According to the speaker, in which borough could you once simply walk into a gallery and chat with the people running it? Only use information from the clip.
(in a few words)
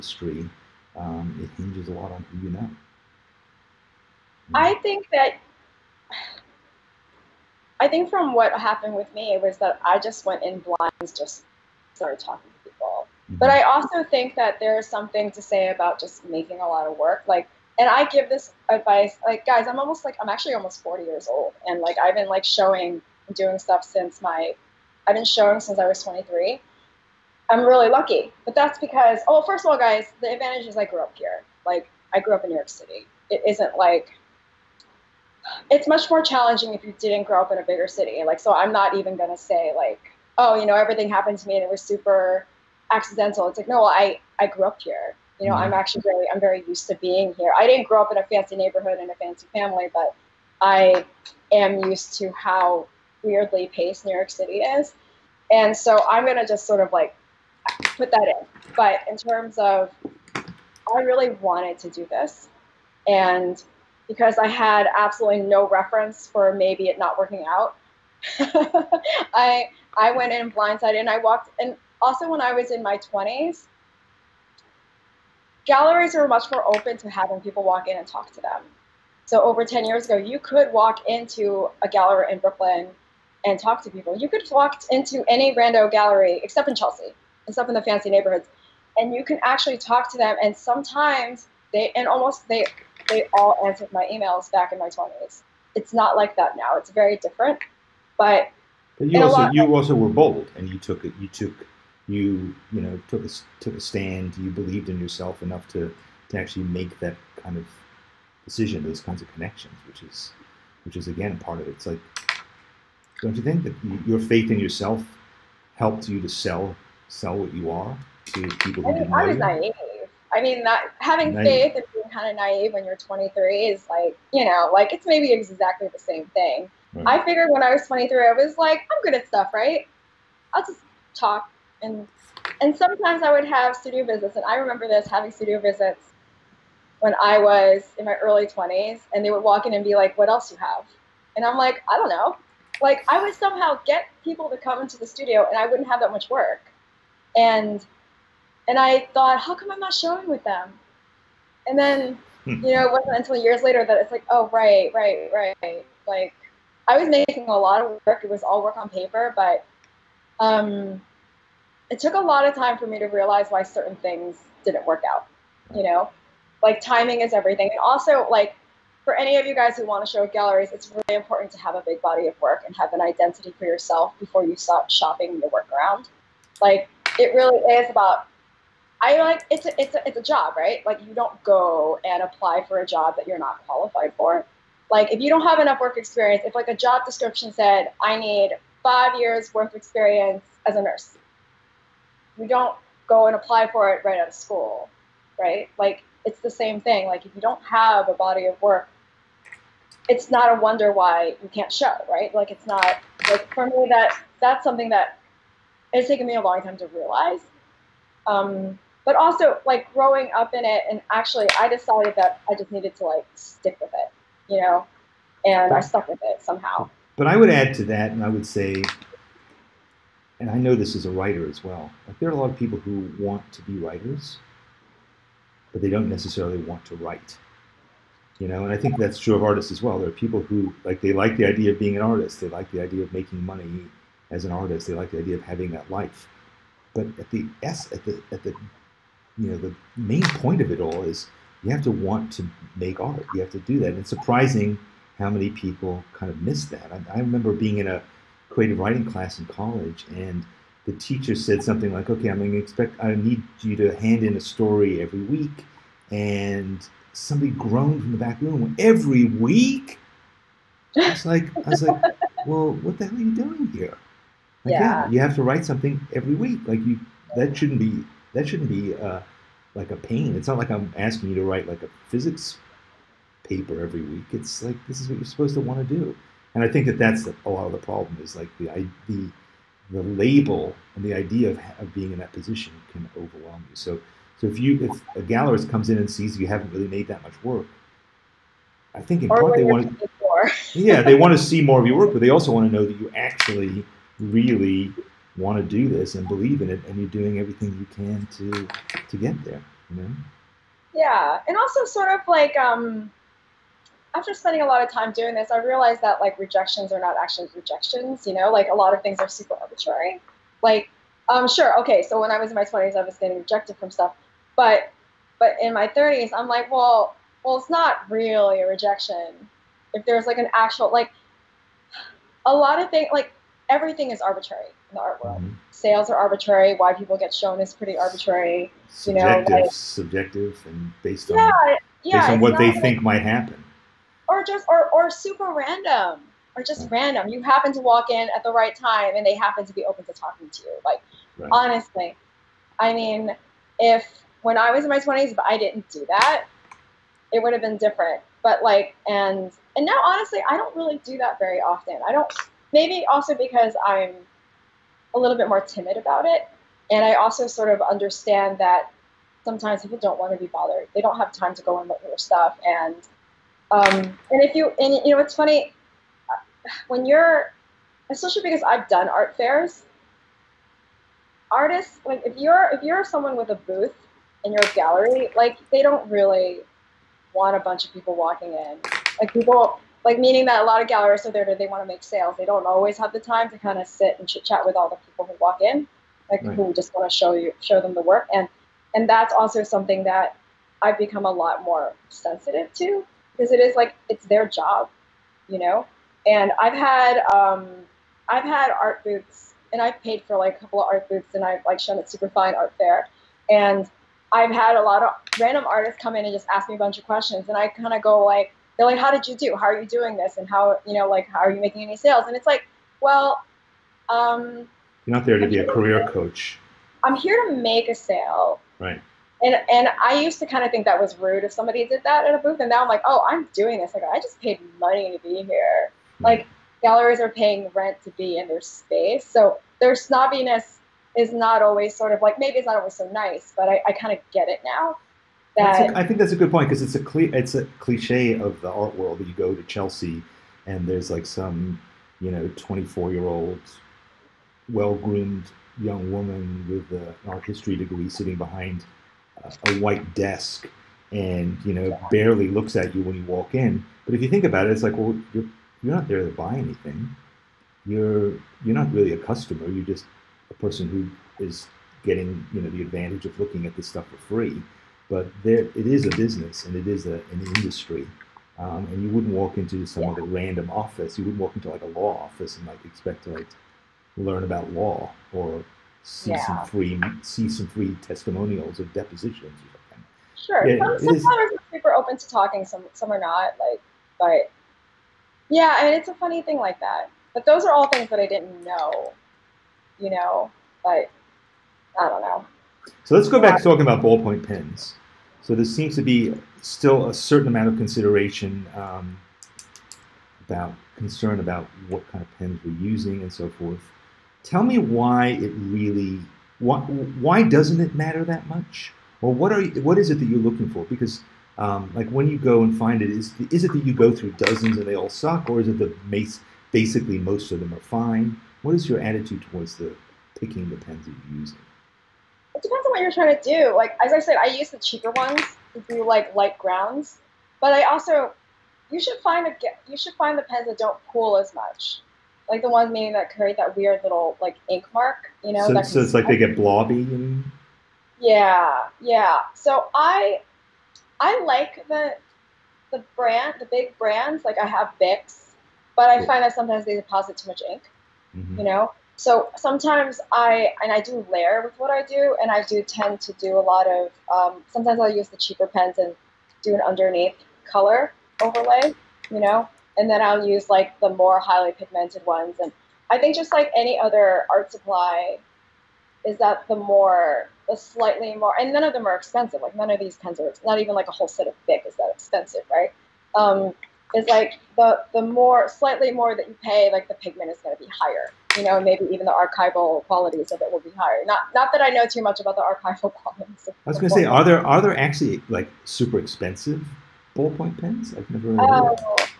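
Brooklyn.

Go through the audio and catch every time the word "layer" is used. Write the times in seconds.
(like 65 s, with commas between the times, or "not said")
551 s.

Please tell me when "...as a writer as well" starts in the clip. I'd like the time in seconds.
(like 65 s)
220 s.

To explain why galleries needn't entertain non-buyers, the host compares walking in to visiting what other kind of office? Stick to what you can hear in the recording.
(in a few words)
A law office.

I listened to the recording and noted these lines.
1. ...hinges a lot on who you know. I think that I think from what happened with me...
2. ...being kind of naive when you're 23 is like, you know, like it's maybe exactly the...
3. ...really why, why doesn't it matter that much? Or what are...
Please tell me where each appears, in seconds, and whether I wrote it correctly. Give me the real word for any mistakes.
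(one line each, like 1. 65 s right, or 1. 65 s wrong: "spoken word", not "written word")
1. 1 s right
2. 121 s right
3. 505 s right.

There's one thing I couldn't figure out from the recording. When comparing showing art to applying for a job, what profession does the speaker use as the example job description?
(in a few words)
Nurse.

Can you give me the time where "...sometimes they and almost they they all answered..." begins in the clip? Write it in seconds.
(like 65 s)
90 s.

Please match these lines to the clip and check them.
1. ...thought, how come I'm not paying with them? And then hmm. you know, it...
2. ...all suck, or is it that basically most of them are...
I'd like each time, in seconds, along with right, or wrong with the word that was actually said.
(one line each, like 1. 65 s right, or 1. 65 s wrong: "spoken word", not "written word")
1. 149 s wrong: "showing", not "paying"
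2. 514 s right.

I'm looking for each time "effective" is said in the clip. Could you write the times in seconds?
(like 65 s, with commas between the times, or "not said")
not said.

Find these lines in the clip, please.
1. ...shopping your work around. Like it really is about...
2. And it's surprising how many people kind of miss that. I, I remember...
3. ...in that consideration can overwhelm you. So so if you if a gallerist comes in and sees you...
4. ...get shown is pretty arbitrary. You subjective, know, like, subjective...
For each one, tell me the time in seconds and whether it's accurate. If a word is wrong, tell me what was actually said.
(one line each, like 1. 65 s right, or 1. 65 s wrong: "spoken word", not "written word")
1. 174 s right
2. 243 s right
3. 282 s wrong: "position", not "consideration"
4. 327 s right.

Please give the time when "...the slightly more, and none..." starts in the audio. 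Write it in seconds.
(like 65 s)
567 s.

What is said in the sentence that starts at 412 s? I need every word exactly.
And it's like, well, um, you're not there to I'm be a career to, coach.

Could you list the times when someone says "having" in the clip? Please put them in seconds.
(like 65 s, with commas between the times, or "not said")
77 s, 120 s, 135 s, 235 s.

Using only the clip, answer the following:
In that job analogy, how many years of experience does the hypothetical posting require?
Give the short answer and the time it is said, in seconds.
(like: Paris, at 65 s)
5 years, at 188 s.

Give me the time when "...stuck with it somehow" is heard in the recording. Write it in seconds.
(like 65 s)
215 s.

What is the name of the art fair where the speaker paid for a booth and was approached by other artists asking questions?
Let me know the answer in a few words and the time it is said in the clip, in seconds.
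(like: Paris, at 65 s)
Super Fine Art Fair, at 402 s.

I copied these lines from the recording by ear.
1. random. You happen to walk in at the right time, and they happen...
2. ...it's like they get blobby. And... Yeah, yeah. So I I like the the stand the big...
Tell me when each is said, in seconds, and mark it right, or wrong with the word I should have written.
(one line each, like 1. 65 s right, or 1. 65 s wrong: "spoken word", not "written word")
1. 336 s right
2. 536 s wrong: "brand", not "stand".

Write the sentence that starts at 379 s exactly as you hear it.
Like people like meaning that a lot of galleries are there to they want to make sales.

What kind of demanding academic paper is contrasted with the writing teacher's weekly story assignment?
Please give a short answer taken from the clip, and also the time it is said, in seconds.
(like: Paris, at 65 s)
A physics paper, at 272 s.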